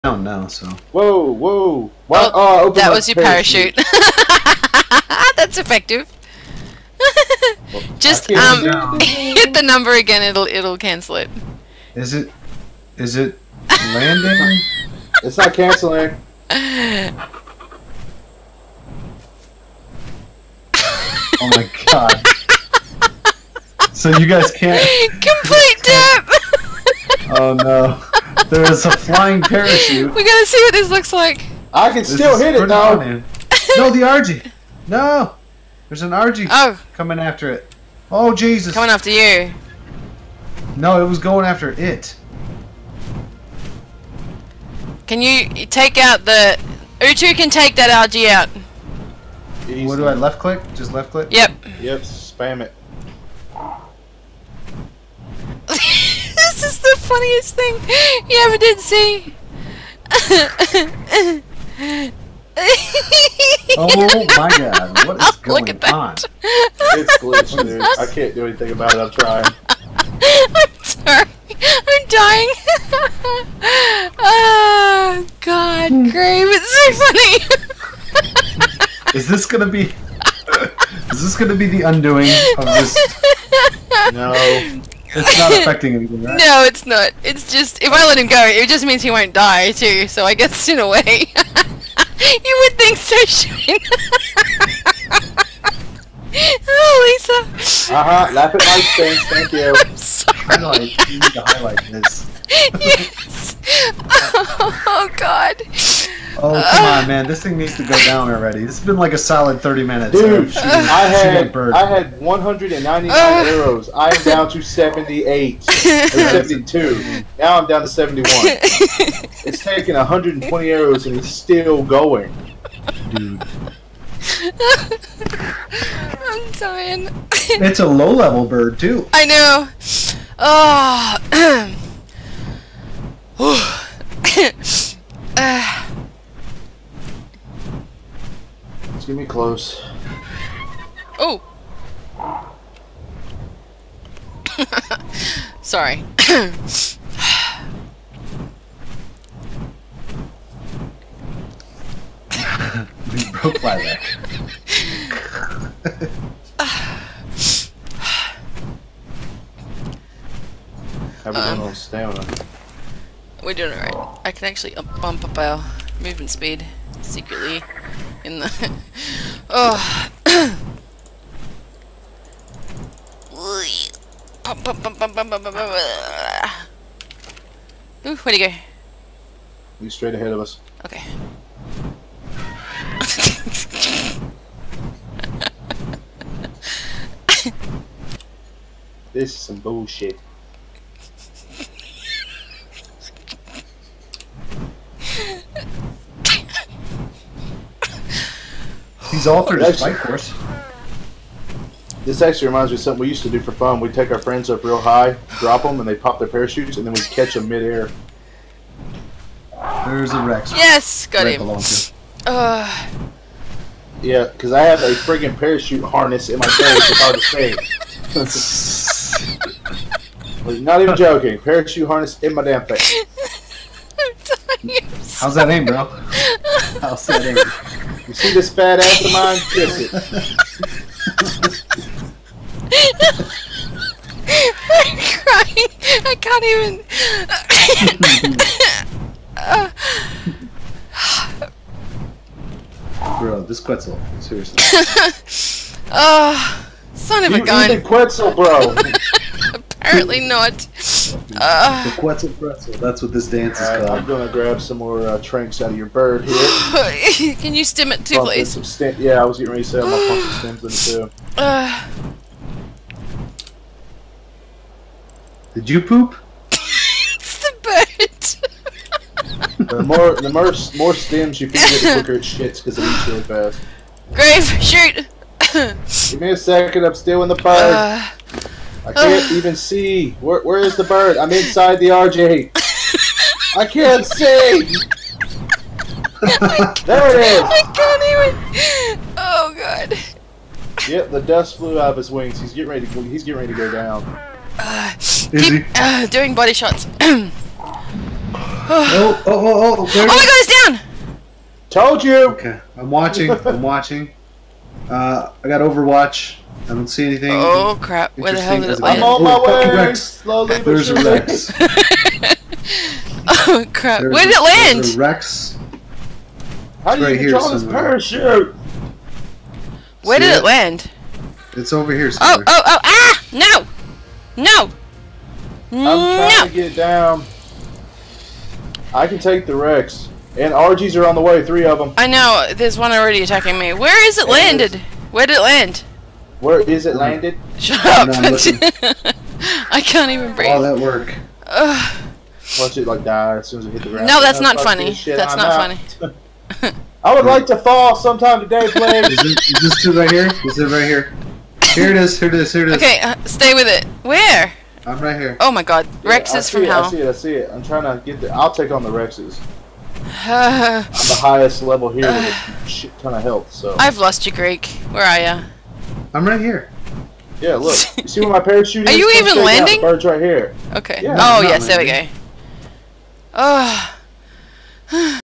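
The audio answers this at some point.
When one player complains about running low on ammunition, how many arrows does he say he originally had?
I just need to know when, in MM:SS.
01:52.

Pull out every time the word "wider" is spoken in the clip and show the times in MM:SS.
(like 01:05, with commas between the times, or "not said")
not said.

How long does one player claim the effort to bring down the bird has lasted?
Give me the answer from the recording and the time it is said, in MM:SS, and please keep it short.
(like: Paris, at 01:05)
30 minutes, at 01:49.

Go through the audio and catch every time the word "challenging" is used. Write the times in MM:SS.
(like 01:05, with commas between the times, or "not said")
not said.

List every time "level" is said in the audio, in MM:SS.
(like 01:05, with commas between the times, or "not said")
02:08, 06:01.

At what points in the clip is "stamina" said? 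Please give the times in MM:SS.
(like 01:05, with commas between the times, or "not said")
02:41.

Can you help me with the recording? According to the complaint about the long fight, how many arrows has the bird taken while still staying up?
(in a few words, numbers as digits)
120.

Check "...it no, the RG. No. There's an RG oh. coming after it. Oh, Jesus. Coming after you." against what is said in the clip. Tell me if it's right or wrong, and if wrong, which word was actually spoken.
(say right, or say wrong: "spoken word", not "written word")
right.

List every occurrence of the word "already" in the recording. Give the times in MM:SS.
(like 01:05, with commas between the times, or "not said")
01:48, 05:32.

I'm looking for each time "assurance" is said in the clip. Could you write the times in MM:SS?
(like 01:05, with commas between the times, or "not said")
not said.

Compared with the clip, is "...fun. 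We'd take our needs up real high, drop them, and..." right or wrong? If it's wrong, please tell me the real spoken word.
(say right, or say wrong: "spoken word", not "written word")
wrong: "friends", not "needs".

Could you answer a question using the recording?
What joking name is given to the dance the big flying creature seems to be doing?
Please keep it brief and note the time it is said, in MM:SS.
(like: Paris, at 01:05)
The Quetzal Pretzel, at 04:11.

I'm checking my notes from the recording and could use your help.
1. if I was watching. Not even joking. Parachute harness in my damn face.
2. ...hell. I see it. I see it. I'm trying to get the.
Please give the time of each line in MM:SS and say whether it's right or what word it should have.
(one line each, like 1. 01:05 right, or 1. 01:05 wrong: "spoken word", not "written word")
1. 03:36 wrong: "saying", not "watching"
2. 05:56 right.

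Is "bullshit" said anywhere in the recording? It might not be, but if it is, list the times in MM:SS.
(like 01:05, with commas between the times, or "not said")
03:09.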